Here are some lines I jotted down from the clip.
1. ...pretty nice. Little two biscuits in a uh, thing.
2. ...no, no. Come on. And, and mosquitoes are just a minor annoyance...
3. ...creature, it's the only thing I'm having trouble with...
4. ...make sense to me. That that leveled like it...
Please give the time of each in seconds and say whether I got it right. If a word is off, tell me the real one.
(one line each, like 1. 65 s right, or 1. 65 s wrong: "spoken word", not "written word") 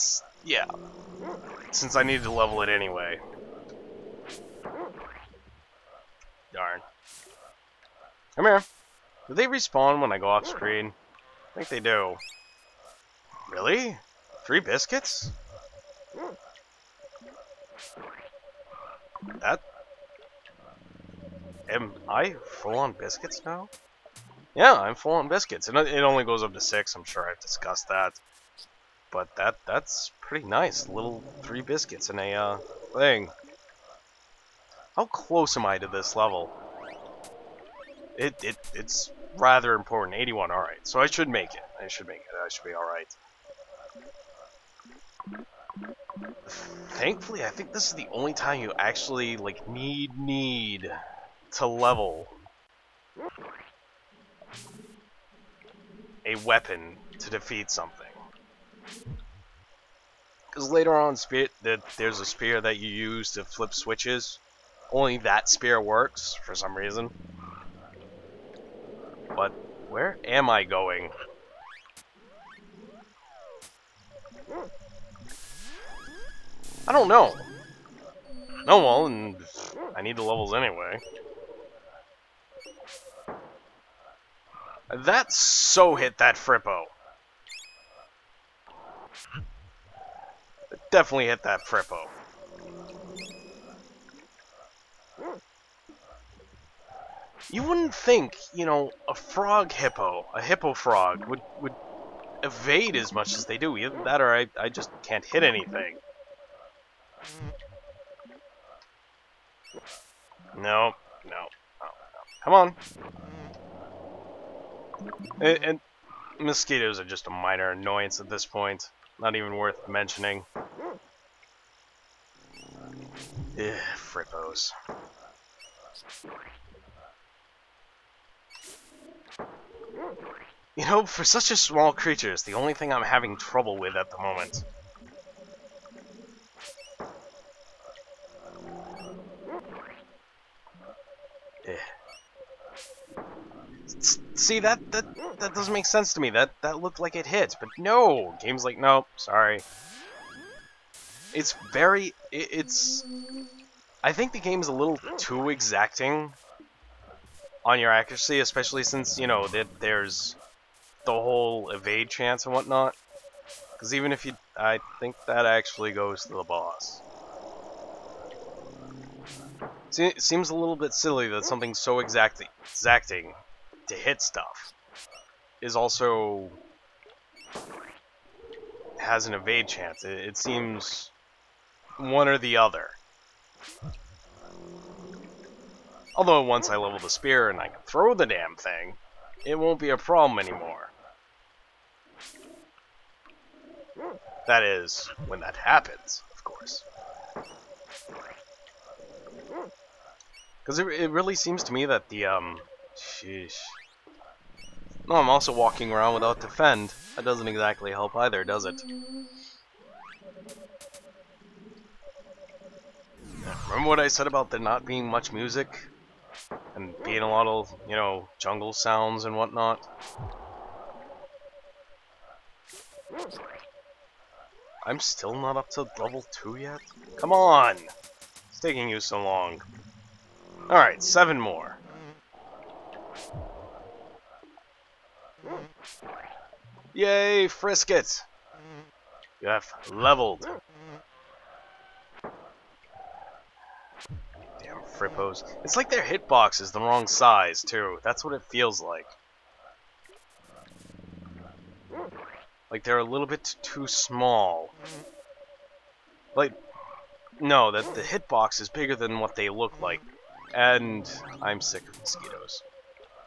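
1. 30 s wrong: "three", not "two"
2. 111 s right
3. 131 s right
4. 145 s wrong: "looked", not "leveled".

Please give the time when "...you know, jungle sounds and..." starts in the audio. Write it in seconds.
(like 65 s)
217 s.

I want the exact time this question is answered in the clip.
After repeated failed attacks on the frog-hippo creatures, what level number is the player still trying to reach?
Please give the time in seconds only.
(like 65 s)
225 s.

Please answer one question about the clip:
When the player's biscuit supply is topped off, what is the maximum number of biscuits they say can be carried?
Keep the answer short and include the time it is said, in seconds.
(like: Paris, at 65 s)
6, at 26 s.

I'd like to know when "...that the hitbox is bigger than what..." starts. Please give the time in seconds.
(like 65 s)
257 s.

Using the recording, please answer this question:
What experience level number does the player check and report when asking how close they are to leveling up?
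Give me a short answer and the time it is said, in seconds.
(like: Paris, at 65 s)
81, at 40 s.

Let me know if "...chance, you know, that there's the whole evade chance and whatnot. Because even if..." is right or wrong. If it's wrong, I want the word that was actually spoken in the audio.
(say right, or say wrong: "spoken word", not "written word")
wrong: "since", not "chance".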